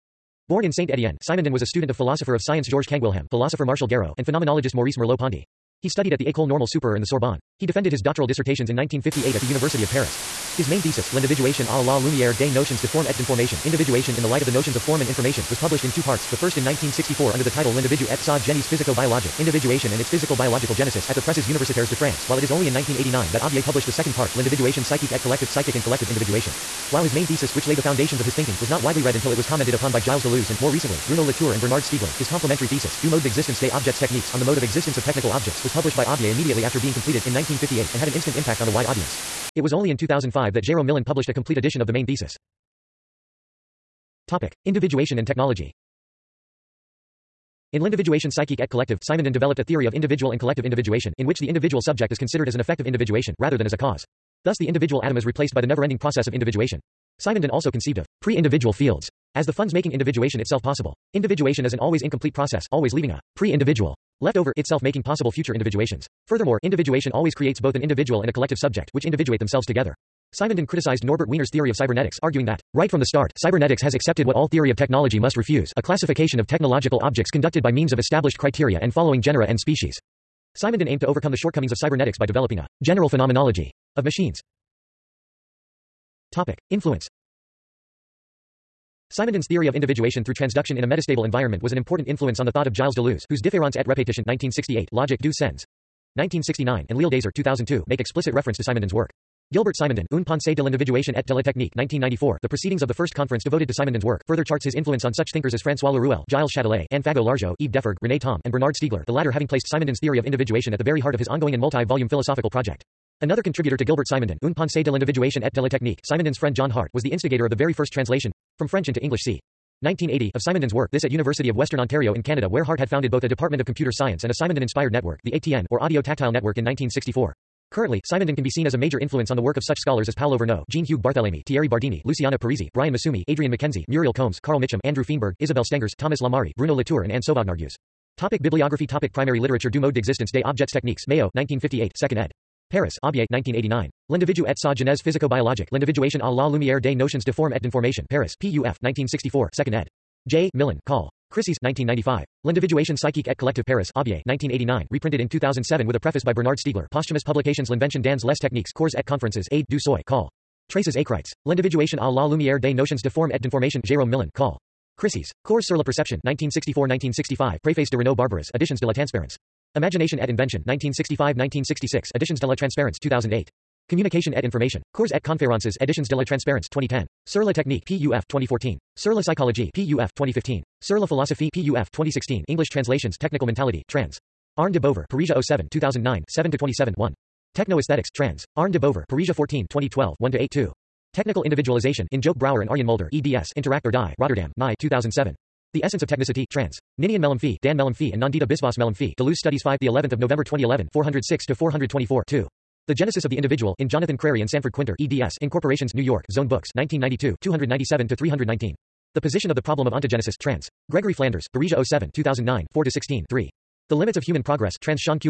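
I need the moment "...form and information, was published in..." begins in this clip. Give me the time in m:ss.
0:14.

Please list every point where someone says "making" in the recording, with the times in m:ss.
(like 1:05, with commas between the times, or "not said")
0:59, 1:04.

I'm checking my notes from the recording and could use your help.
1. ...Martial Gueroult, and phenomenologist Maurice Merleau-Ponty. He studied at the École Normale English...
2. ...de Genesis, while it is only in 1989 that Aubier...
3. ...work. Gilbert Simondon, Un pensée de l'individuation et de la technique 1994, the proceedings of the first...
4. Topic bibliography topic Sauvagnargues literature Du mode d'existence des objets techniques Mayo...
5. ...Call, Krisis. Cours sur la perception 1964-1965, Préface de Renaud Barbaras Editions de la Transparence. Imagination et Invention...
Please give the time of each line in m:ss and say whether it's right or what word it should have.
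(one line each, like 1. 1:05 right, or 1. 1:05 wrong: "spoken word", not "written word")
1. 0:03 wrong: "Supérieure", not "English"
2. 0:21 wrong: "France", not "Genesis"
3. 1:38 right
4. 2:18 wrong: "Primary", not "Sauvagnargues"
5. 2:44 right.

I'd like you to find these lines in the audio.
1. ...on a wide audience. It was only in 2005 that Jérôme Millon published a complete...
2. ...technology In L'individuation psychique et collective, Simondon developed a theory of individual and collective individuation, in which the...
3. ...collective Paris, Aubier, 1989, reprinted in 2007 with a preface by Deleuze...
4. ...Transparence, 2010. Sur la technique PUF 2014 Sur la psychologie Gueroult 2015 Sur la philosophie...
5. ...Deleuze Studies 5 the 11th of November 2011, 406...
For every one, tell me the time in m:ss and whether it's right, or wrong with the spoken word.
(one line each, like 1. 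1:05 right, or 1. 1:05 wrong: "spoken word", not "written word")
1. 0:38 right
2. 0:45 right
3. 2:33 wrong: "Bernard", not "Deleuze"
4. 2:56 wrong: "PUF", not "Gueroult"
5. 3:19 right.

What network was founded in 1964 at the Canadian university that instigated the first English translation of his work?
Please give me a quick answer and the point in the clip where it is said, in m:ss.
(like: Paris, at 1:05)
Audio Tactile Network, at 2:05.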